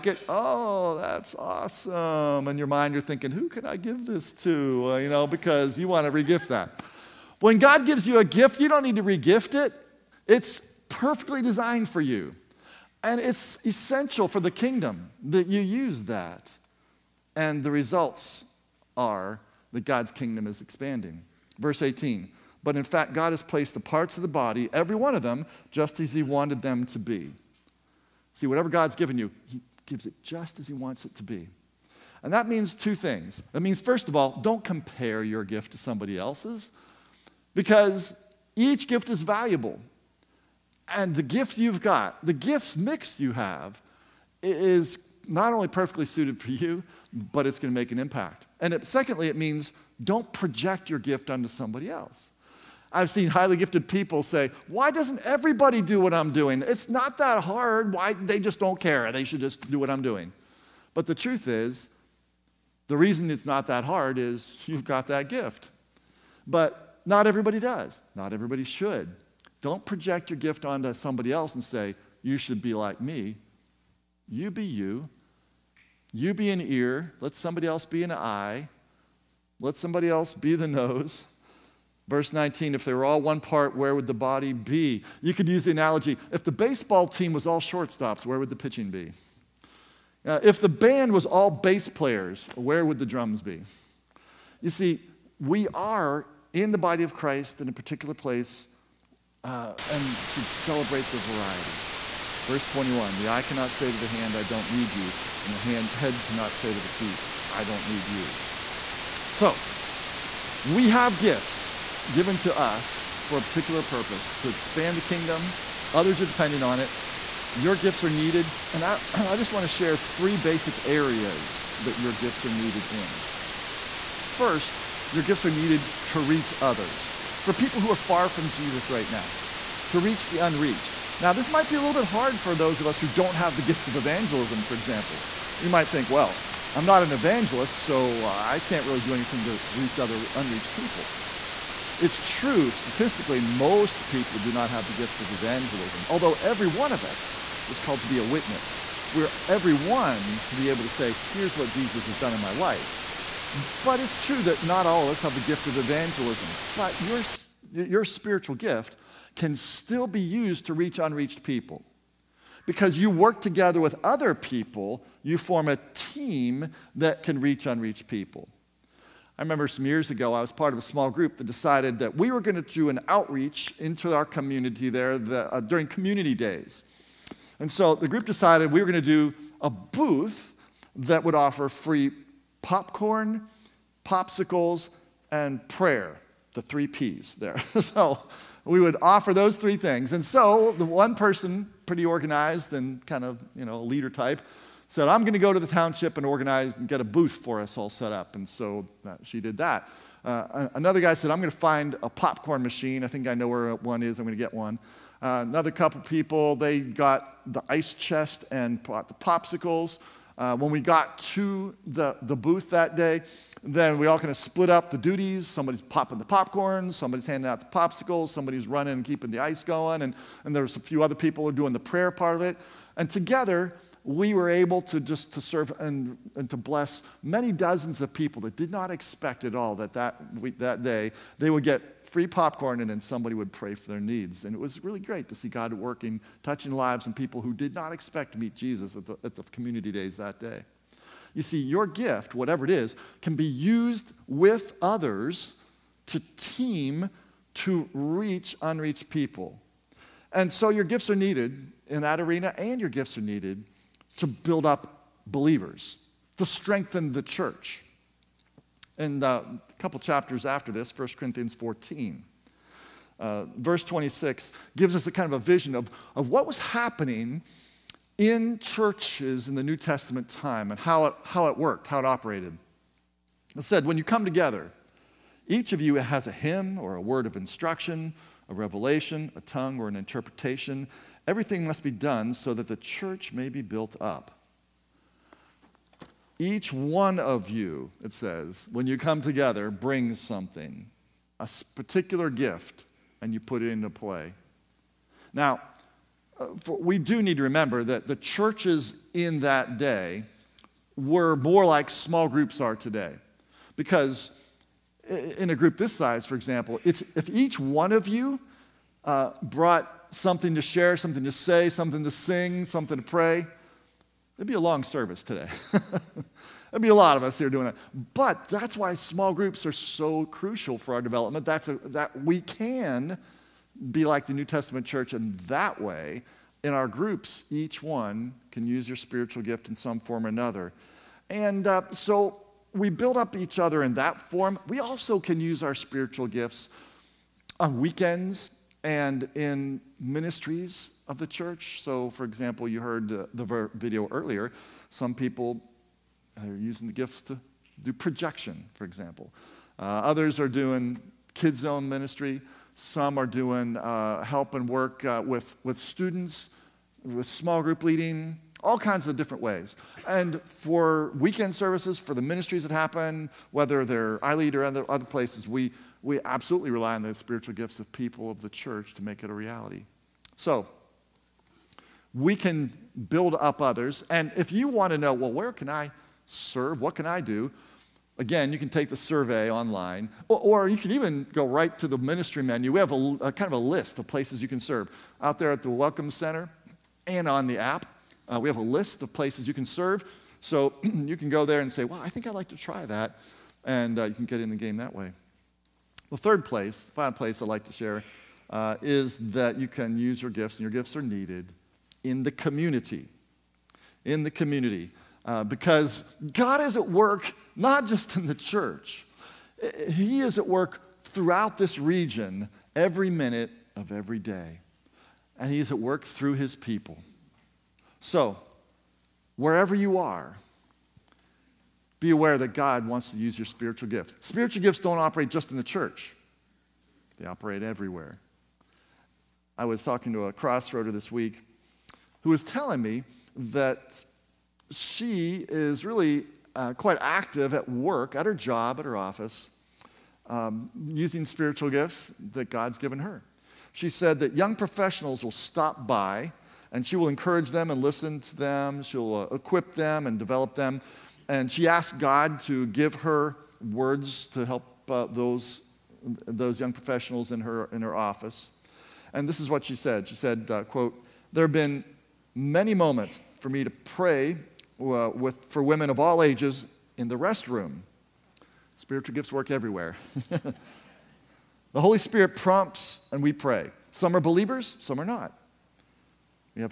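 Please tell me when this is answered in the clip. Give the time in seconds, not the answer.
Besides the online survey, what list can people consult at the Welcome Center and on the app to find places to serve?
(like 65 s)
381 s.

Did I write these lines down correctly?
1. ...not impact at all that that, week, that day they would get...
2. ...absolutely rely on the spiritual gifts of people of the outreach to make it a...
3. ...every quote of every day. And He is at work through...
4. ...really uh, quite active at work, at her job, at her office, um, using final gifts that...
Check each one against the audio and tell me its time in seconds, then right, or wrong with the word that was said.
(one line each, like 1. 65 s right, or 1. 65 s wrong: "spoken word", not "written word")
1. 228 s wrong: "expect", not "impact"
2. 366 s wrong: "church", not "outreach"
3. 412 s wrong: "minute", not "quote"
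4. 435 s wrong: "spiritual", not "final".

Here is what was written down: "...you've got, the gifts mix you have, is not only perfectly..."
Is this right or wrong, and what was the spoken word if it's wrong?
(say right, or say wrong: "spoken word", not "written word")
right.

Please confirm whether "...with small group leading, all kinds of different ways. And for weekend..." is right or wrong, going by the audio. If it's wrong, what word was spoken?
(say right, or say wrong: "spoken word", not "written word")
right.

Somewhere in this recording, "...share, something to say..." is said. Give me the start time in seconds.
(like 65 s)
310 s.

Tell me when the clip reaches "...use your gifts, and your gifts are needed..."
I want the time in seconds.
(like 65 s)
399 s.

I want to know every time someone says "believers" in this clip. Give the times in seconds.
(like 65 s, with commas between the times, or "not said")
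255 s, 474 s.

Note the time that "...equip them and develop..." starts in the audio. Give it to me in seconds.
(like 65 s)
449 s.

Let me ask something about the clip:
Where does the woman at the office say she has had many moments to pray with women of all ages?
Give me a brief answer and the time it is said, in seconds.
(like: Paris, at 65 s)
the restroom, at 467 s.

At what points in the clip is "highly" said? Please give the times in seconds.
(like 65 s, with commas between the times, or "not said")
53 s.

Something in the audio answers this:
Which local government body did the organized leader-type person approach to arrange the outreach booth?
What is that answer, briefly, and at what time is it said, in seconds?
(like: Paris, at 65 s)
the township, at 195 s.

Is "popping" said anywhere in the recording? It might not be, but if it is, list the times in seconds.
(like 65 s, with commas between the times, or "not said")
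215 s.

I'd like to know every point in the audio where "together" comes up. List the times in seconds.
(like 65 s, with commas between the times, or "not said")
163 s, 223 s, 274 s, 289 s.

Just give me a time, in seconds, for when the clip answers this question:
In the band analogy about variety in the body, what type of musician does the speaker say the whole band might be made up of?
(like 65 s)
91 s.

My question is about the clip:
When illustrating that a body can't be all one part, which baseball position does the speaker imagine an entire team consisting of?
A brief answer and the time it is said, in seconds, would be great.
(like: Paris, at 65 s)
shortstops, at 87 s.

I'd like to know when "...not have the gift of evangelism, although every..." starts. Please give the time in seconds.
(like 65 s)
144 s.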